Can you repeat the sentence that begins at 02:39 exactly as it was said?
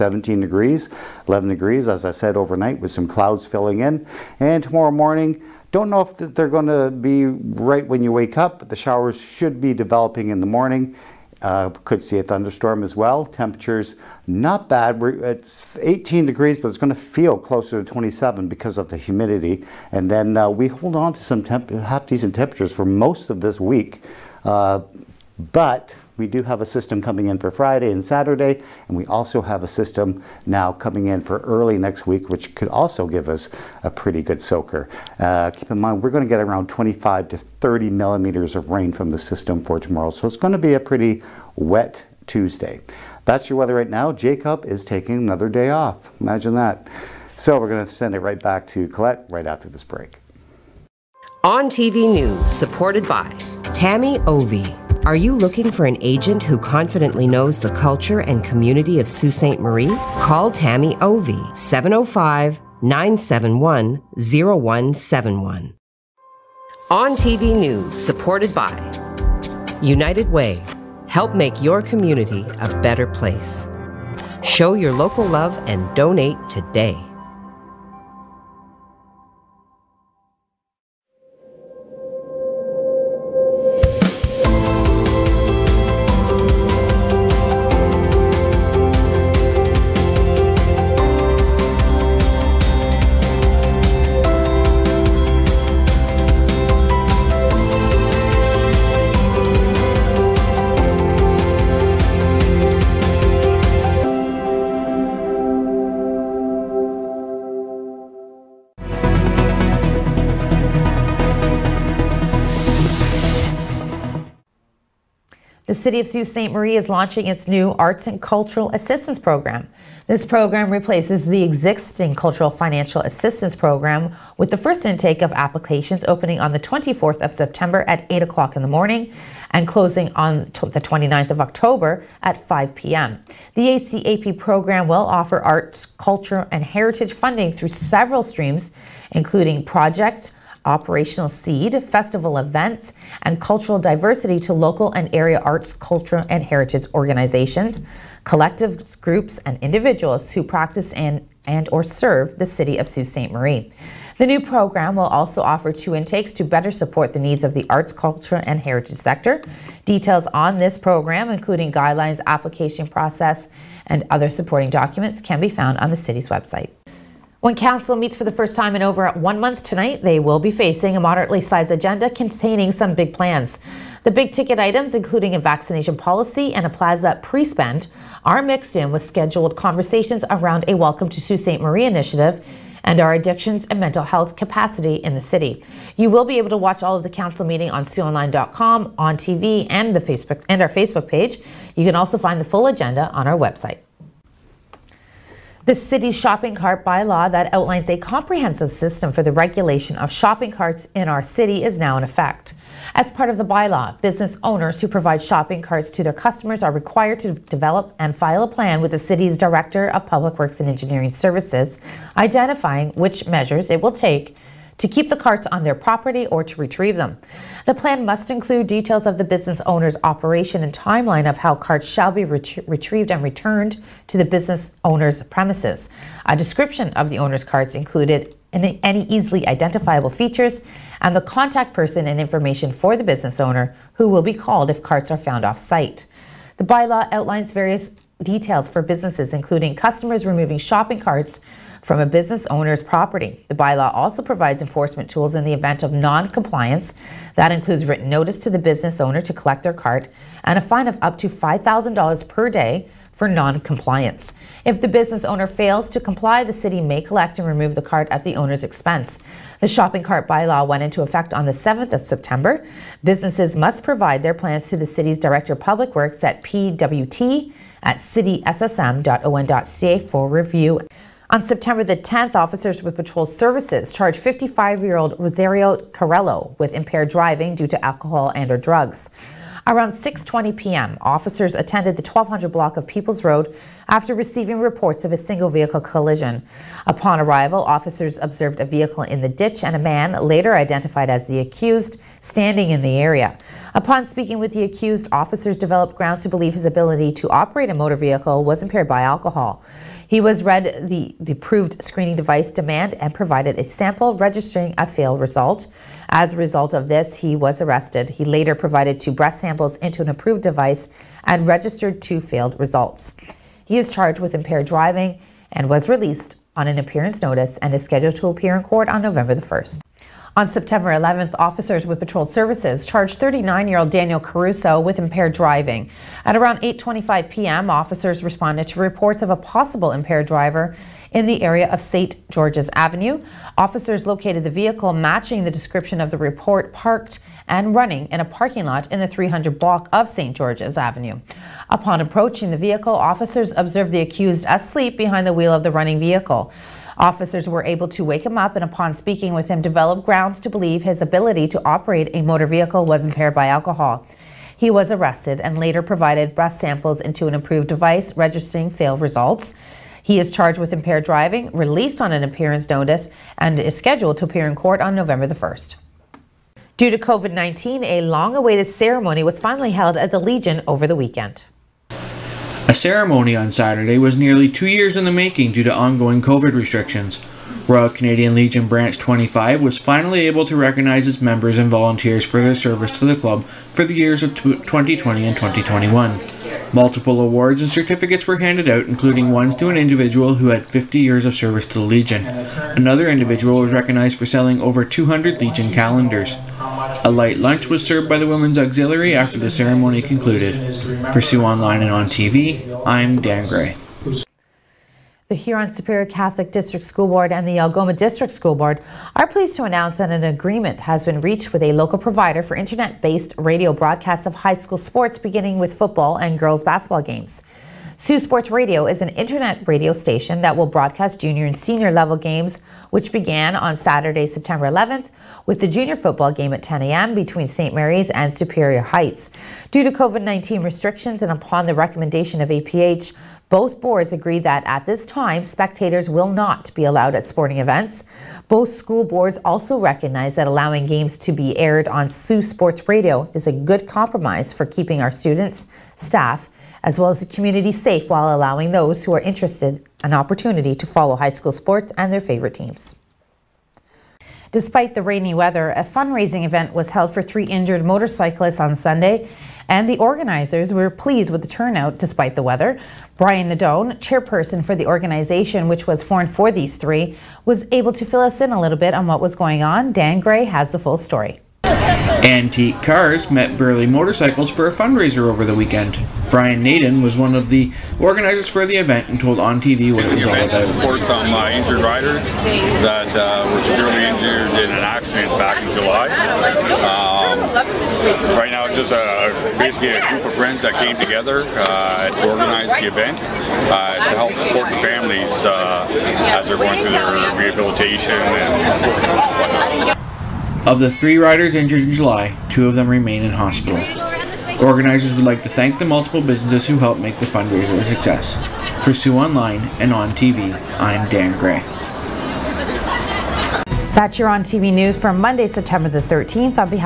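Details on this program, including guidelines, application process, and other supporting documents, can be found on the city's website.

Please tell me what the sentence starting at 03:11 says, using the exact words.
You can also find the full agenda on our website.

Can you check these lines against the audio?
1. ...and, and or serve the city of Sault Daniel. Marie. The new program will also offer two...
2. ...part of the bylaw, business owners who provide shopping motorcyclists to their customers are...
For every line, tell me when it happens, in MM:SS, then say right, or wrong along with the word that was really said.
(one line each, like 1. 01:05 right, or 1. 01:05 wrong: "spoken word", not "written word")
1. 02:30 wrong: "Ste", not "Daniel"
2. 03:23 wrong: "carts", not "motorcyclists".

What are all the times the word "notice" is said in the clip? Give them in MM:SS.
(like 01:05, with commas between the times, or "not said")
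04:08, 05:17, 06:02.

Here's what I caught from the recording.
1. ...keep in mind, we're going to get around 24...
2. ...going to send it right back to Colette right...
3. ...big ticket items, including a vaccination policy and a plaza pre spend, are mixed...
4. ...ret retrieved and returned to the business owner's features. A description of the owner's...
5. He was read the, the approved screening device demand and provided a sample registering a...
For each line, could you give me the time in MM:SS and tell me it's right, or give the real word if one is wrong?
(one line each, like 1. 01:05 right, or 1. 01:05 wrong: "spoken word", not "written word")
1. 00:35 wrong: "25", not "24"
2. 00:47 right
3. 02:54 right
4. 03:42 wrong: "premises", not "features"
5. 05:00 right.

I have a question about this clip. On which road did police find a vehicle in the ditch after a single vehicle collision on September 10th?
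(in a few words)
People's Road.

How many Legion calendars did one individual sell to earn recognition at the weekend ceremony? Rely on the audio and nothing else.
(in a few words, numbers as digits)
over 200.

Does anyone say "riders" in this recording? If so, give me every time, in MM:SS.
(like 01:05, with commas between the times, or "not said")
08:01, 08:21.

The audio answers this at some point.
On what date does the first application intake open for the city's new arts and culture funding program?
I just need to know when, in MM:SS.
02:06.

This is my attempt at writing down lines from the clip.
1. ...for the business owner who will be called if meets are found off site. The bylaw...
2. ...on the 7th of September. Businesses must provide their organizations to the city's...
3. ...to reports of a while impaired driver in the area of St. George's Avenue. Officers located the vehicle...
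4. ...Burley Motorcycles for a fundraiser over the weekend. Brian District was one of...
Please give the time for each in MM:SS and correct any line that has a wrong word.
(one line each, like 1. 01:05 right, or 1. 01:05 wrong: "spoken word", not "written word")
1. 03:52 wrong: "carts", not "meets"
2. 04:21 wrong: "plans", not "organizations"
3. 05:28 wrong: "possible", not "while"
4. 07:53 wrong: "Naden", not "District".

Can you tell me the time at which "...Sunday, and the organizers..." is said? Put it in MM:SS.
07:38.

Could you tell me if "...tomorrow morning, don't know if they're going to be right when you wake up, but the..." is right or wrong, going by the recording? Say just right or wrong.
right.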